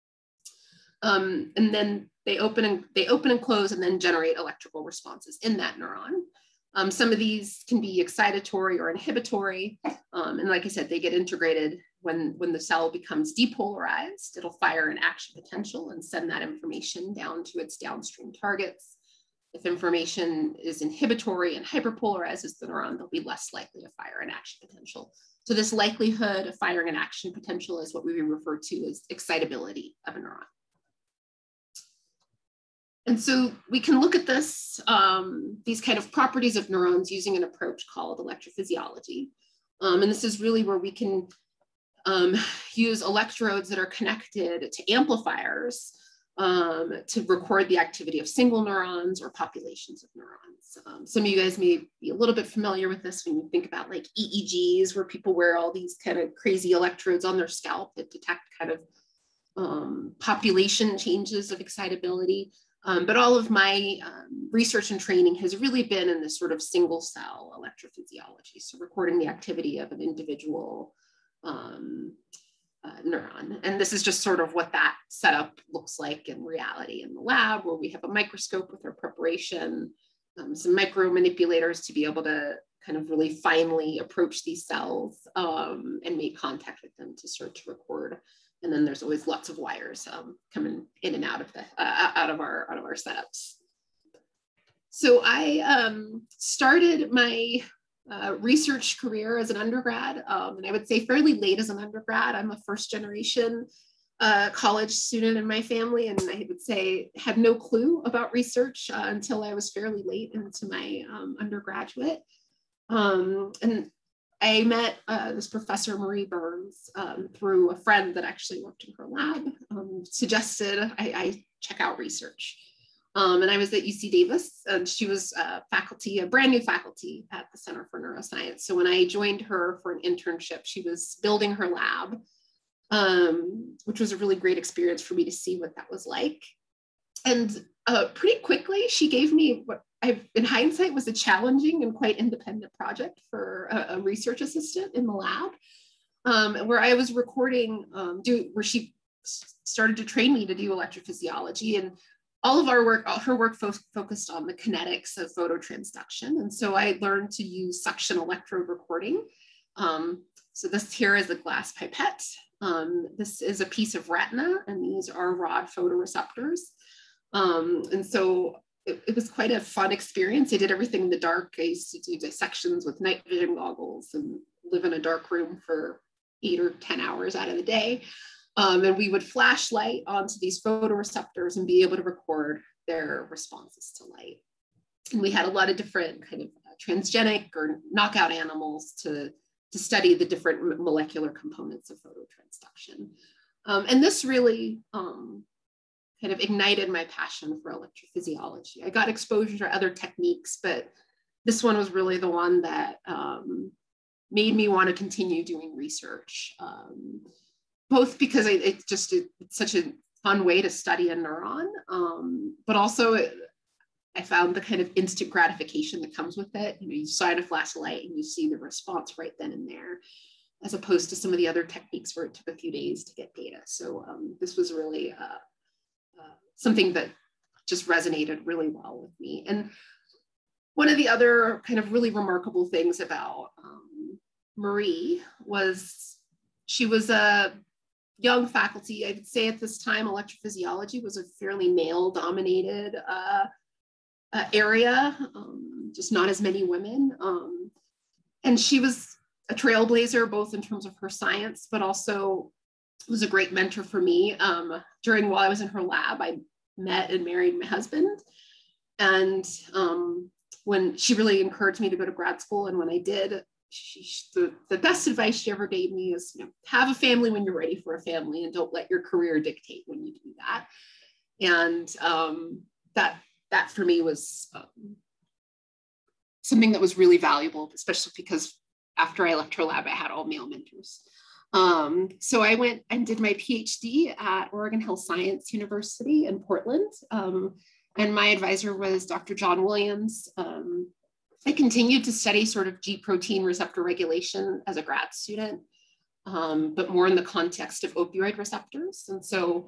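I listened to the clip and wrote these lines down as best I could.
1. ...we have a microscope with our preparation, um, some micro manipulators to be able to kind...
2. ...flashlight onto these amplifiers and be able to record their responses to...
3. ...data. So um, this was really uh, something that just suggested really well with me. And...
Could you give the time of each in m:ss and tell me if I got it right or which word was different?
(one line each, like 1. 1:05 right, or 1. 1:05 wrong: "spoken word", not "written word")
1. 1:17 right
2. 2:59 wrong: "photoreceptors", not "amplifiers"
3. 3:43 wrong: "resonated", not "suggested".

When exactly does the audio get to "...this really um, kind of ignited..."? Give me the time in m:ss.
3:14.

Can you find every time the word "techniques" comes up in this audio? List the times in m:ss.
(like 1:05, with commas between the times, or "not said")
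3:19, 3:41.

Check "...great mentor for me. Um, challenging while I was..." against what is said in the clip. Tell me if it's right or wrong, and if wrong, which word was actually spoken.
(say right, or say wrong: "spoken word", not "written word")
wrong: "during", not "challenging".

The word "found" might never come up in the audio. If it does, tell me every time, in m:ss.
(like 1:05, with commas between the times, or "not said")
3:34.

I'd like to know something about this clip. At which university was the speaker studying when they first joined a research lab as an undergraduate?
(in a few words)
UC Davis.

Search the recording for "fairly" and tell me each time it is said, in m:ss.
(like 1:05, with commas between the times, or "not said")
1:41, 1:49, 4:01.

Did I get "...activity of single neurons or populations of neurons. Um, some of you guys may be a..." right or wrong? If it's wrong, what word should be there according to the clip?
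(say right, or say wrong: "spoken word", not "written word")
right.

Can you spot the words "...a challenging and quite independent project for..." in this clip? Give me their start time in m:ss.
2:21.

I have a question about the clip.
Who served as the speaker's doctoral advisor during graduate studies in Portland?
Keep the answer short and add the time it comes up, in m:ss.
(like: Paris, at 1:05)
John Williams, at 4:49.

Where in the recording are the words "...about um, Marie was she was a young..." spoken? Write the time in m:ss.
3:52.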